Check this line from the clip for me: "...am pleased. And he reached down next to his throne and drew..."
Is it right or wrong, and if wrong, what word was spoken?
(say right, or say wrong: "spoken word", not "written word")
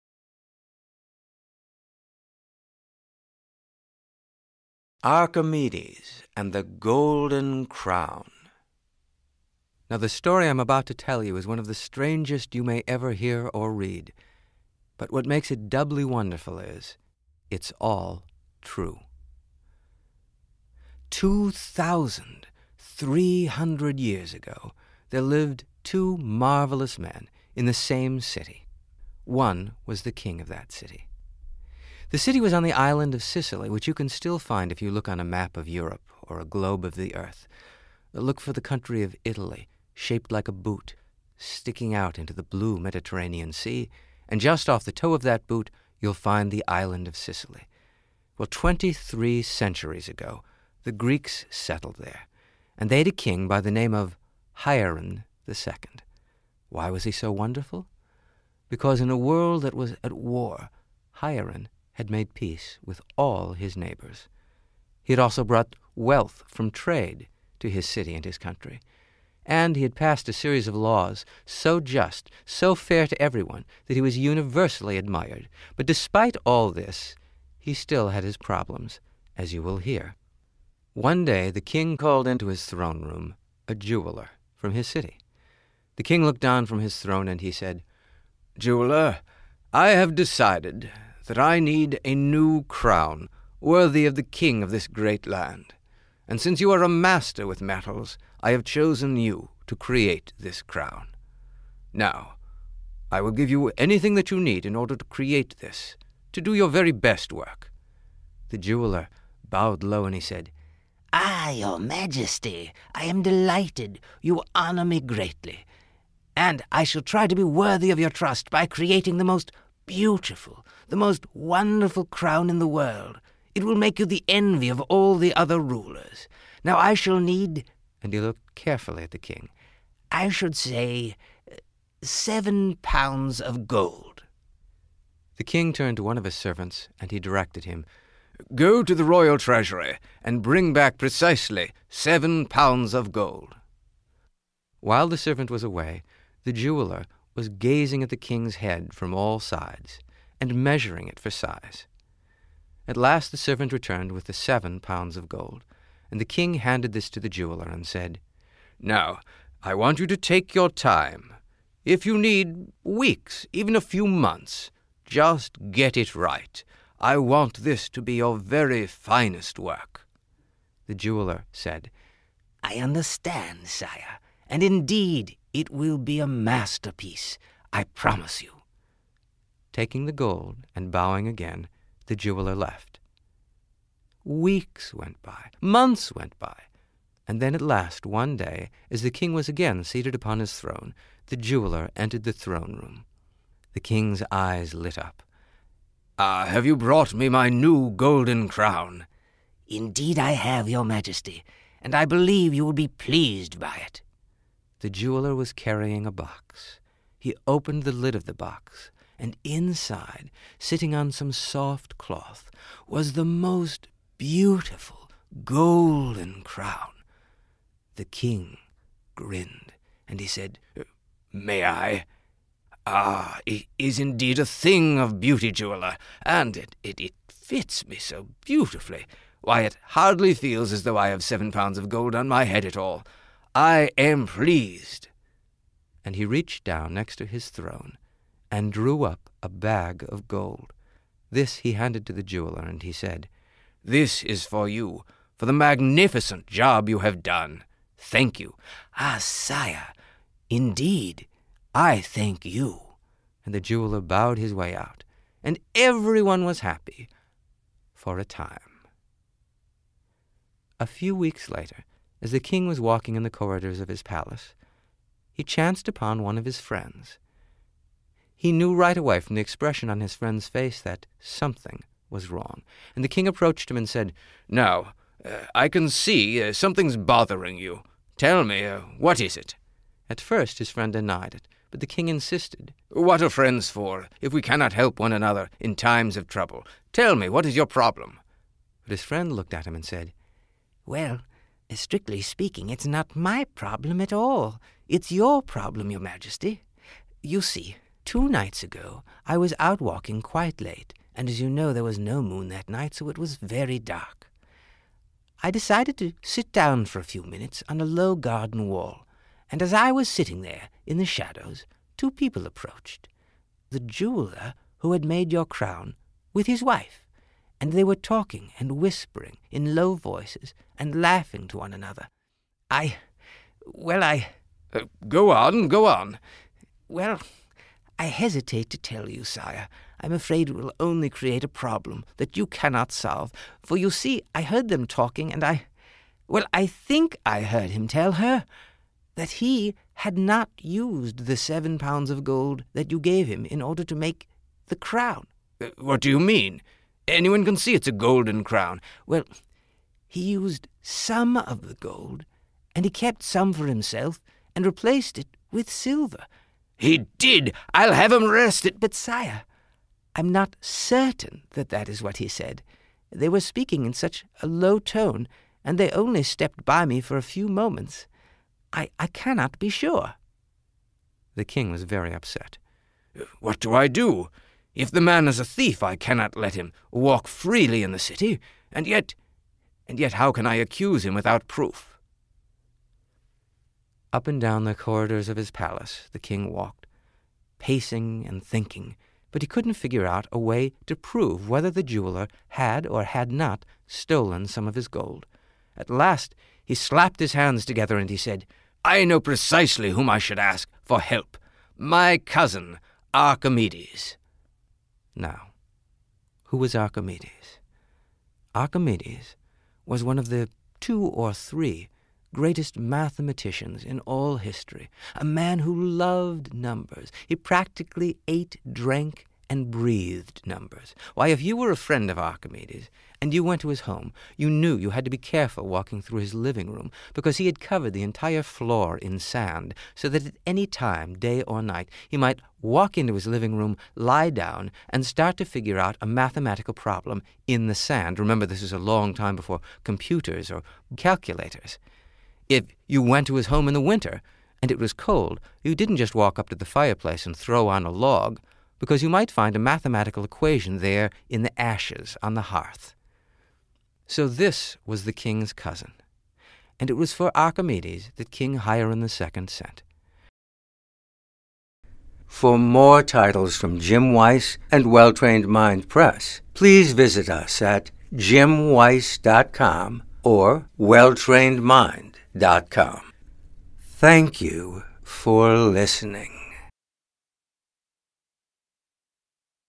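right.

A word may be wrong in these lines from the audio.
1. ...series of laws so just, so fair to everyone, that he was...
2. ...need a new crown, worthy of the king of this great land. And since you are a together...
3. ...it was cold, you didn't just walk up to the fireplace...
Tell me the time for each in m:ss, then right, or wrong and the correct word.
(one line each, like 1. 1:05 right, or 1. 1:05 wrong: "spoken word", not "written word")
1. 1:10 right
2. 1:31 wrong: "master", not "together"
3. 7:24 right.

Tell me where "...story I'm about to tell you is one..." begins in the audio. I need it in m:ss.
0:10.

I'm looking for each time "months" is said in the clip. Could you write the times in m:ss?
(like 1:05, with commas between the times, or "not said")
2:44, 3:05.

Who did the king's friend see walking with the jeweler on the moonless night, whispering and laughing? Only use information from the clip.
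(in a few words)
His wife.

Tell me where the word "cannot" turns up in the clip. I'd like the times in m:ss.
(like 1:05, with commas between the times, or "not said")
4:44, 5:32, 6:09, 6:15.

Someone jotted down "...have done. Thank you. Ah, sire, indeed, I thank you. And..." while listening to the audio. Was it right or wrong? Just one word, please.
right.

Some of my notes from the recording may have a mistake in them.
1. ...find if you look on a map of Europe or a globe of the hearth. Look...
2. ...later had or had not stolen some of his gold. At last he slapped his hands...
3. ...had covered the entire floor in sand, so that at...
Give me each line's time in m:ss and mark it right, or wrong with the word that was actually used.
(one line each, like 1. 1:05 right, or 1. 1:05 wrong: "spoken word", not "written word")
1. 0:34 wrong: "earth", not "hearth"
2. 6:31 wrong: "jeweler", not "later"
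3. 7:07 right.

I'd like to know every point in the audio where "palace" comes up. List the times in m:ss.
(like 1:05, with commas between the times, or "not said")
4:24, 6:25.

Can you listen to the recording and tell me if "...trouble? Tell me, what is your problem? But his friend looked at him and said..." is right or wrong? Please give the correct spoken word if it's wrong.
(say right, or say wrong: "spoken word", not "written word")
right.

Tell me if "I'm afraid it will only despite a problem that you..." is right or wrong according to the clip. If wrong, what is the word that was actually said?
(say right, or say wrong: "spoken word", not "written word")
wrong: "create", not "despite".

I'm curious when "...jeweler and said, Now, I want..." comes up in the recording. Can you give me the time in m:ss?
2:37.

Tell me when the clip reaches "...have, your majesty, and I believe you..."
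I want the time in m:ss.
3:20.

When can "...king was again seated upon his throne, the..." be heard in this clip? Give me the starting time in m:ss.
3:09.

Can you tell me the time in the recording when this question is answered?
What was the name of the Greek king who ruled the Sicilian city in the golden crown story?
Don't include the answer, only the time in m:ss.
0:54.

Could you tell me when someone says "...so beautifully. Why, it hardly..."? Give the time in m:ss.
3:47.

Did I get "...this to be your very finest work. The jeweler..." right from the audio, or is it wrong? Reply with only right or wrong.
right.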